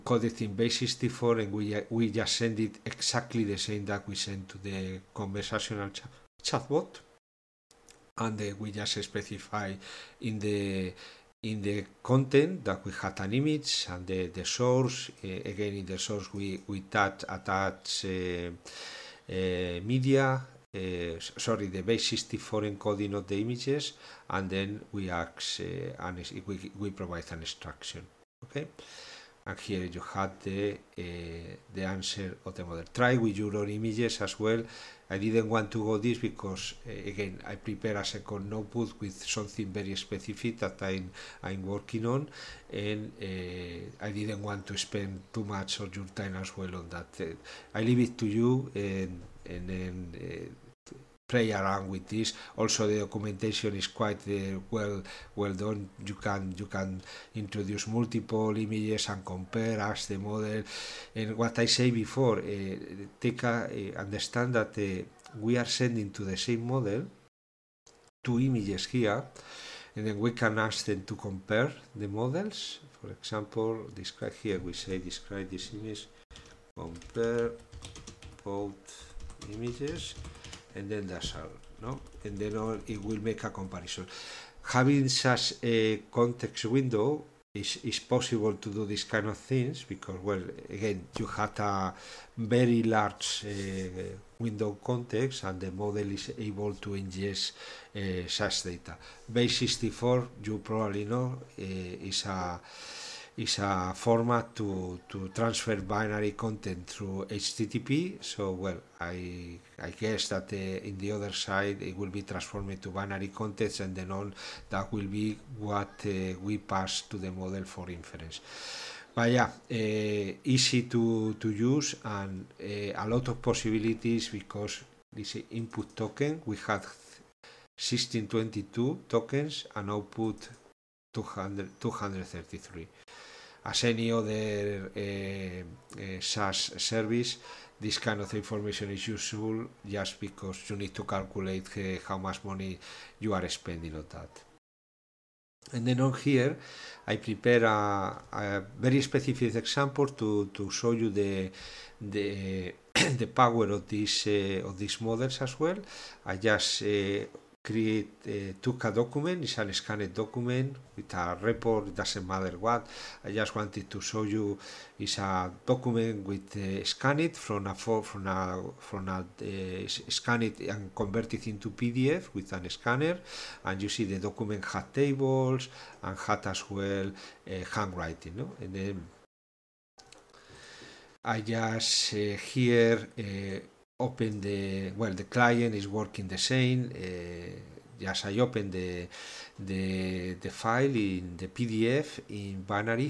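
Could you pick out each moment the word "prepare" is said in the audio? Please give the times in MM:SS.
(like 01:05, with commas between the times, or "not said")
00:37, 02:27.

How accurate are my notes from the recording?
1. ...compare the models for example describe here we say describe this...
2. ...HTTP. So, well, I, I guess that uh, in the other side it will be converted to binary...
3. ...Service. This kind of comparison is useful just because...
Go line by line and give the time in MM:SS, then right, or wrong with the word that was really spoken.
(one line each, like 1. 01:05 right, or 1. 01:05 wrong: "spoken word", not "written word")
1. 01:11 right
2. 01:47 wrong: "transformed", not "converted"
3. 02:16 wrong: "information", not "comparison".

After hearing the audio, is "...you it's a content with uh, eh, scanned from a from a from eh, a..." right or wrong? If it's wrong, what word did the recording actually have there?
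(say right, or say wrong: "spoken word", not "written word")
wrong: "document", not "content".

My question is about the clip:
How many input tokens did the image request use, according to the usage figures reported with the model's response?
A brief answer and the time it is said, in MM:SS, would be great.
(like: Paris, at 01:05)
1622, at 02:06.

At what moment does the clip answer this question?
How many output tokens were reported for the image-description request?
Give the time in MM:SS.
02:11.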